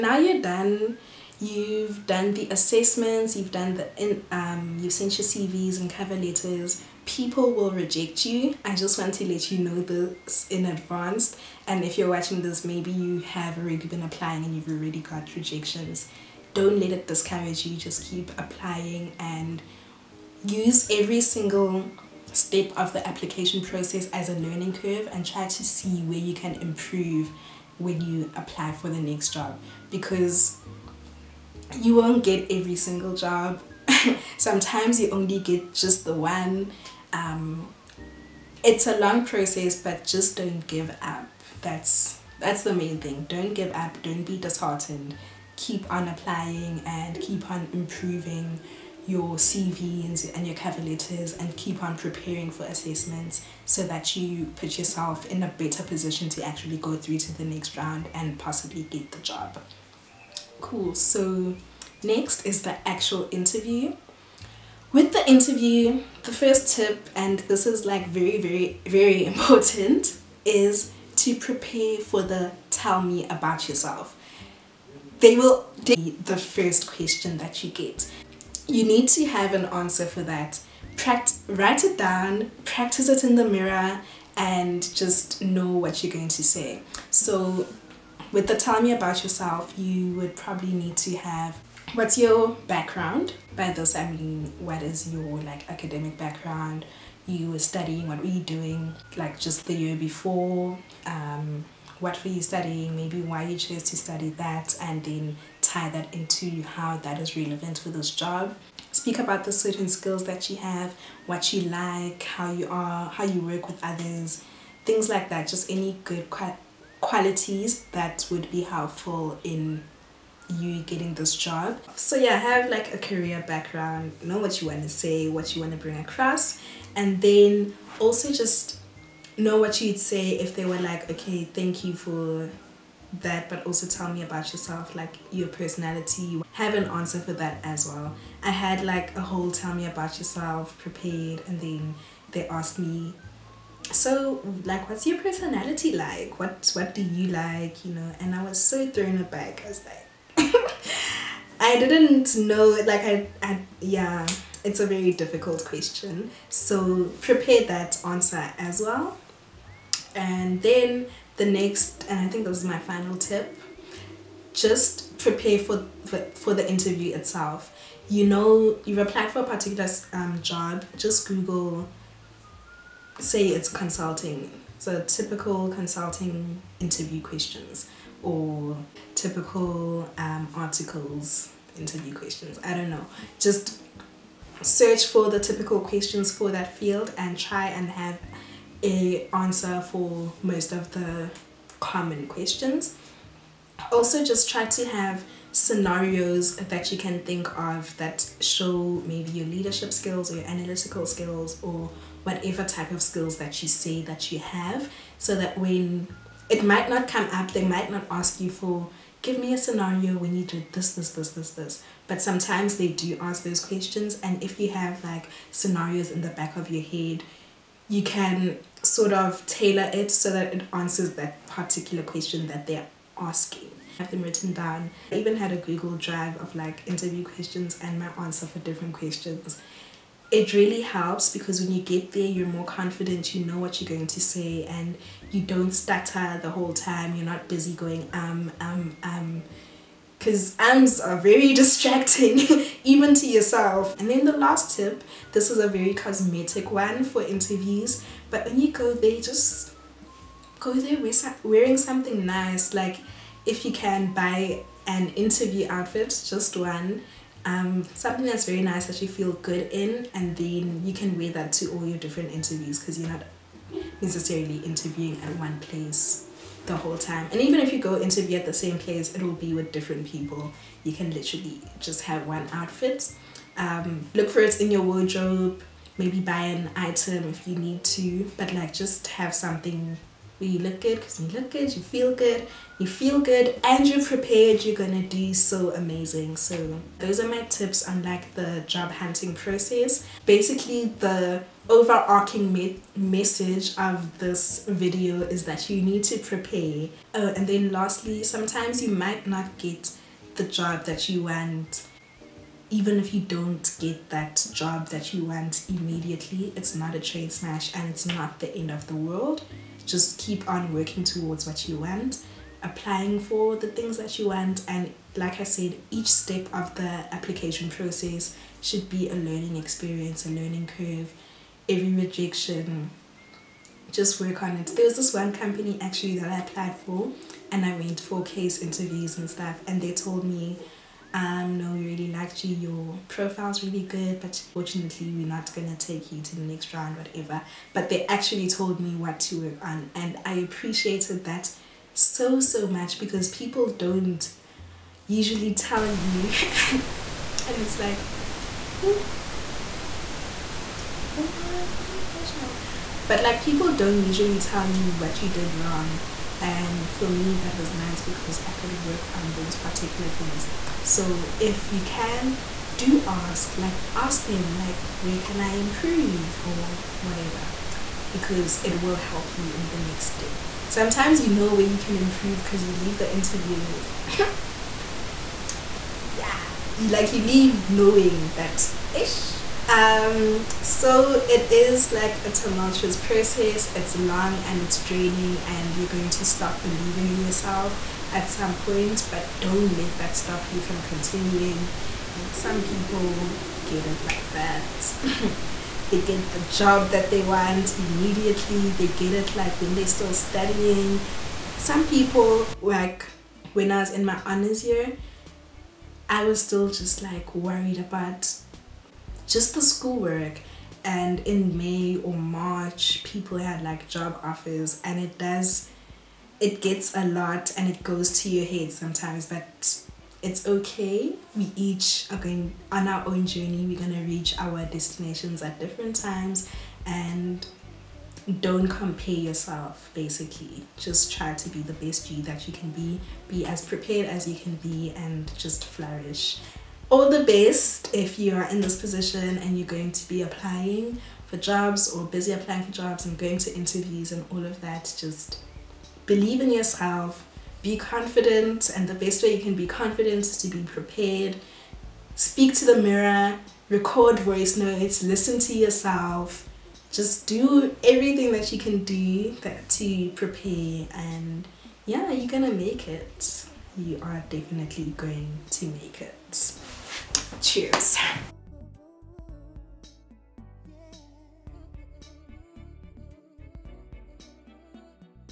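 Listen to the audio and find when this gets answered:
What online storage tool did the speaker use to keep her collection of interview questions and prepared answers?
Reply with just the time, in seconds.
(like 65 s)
225 s.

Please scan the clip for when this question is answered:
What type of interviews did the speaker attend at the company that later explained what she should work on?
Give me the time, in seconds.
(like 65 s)
328 s.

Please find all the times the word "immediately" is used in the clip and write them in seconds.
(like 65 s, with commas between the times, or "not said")
305 s, 397 s.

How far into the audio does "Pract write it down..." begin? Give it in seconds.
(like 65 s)
80 s.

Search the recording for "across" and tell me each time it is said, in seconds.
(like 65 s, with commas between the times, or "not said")
125 s.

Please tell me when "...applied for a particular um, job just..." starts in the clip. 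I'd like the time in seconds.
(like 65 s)
168 s.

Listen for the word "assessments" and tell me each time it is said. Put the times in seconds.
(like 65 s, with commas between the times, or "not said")
2 s, 52 s.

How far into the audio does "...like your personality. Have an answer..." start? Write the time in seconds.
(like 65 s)
134 s.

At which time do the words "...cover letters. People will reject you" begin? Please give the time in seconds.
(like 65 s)
5 s.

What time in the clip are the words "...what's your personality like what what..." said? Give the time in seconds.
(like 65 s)
144 s.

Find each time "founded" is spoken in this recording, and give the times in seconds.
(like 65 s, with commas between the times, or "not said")
not said.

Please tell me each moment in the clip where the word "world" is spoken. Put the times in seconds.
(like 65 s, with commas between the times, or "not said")
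308 s.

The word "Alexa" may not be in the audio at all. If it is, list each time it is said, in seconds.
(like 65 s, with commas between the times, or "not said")
not said.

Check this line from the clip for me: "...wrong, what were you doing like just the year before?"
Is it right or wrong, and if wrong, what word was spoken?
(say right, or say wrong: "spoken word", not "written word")
wrong: "studying", not "wrong".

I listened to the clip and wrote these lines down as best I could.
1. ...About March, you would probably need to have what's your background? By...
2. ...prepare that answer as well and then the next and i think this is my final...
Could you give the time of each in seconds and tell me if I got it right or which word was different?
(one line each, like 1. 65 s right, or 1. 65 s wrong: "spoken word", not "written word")
1. 88 s wrong: "Yourself", not "March"
2. 157 s right.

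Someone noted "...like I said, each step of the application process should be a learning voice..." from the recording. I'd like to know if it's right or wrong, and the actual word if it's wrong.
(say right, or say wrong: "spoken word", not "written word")
wrong: "experience", not "voice".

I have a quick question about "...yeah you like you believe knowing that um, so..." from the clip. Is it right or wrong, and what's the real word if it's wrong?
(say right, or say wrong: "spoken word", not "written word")
wrong: "leave", not "believe".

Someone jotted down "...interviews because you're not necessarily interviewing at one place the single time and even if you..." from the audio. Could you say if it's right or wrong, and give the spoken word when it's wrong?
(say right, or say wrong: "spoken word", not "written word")
wrong: "whole", not "single".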